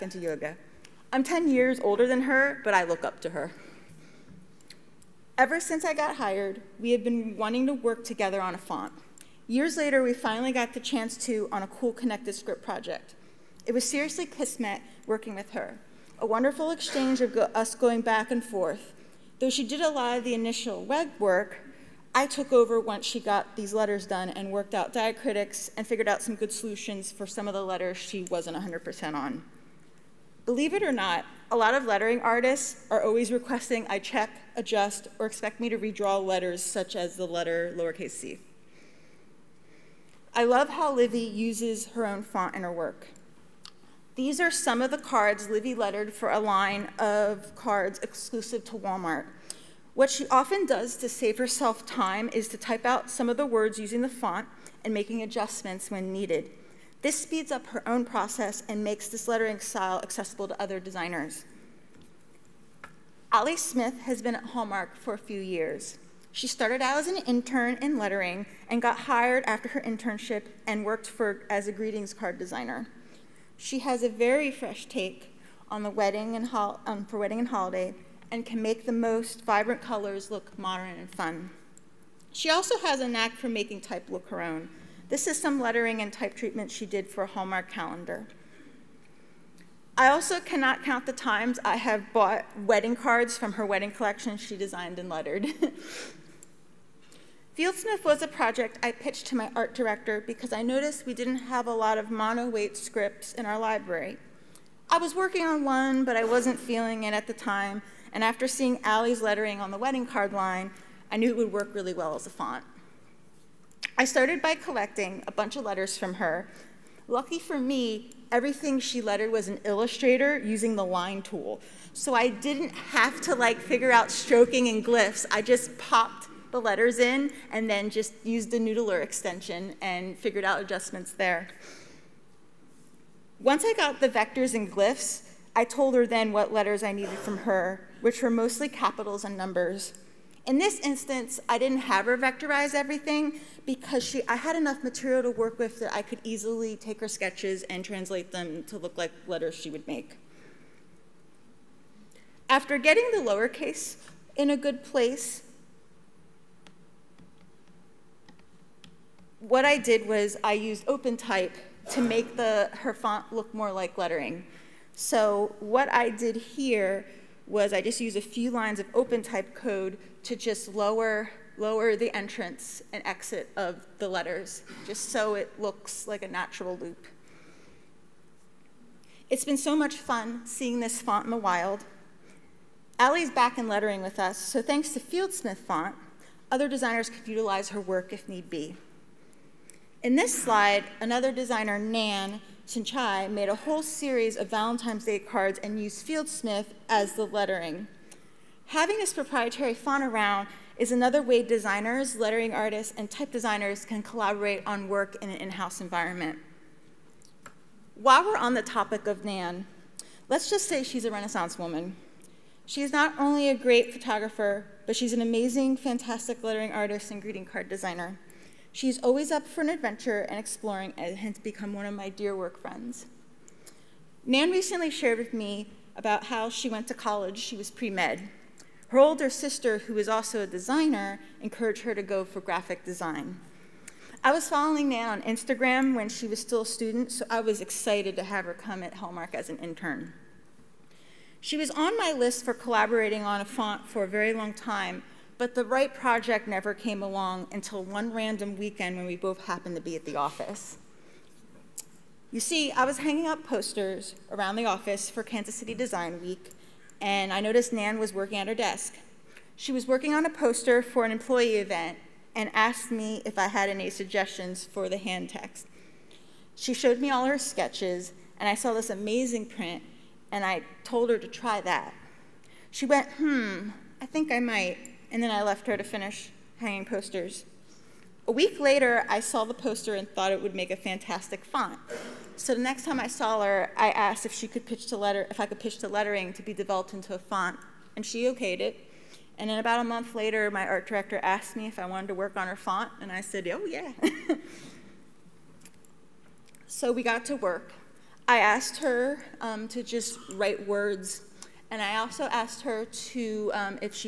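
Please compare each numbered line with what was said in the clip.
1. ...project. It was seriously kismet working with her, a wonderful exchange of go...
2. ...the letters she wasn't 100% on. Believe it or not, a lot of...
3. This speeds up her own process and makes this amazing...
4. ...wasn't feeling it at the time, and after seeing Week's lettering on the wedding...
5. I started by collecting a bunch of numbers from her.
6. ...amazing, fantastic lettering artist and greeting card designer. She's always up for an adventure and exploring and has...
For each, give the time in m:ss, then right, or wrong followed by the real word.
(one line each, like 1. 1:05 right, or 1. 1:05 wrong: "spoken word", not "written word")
1. 0:12 right
2. 0:27 right
3. 0:57 wrong: "lettering", not "amazing"
4. 1:46 wrong: "Allie", not "Week"
5. 1:53 wrong: "letters", not "numbers"
6. 3:35 right.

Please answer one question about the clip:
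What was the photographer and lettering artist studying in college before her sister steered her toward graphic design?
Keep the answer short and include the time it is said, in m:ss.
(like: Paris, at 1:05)
Pre-med, at 3:47.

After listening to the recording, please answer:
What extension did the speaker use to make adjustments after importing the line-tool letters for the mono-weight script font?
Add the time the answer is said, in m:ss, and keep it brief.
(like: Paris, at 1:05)
Noodler, at 2:08.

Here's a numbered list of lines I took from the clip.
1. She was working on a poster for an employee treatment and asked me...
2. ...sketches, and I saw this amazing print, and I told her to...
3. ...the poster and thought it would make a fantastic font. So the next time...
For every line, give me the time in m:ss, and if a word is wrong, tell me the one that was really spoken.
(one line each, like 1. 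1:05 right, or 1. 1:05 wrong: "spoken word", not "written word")
1. 4:19 wrong: "event", not "treatment"
2. 4:27 right
3. 4:39 right.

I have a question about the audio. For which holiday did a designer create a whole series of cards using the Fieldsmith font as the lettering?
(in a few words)
Valentine's Day.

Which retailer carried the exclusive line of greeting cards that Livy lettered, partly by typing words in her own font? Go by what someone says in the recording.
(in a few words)
Walmart.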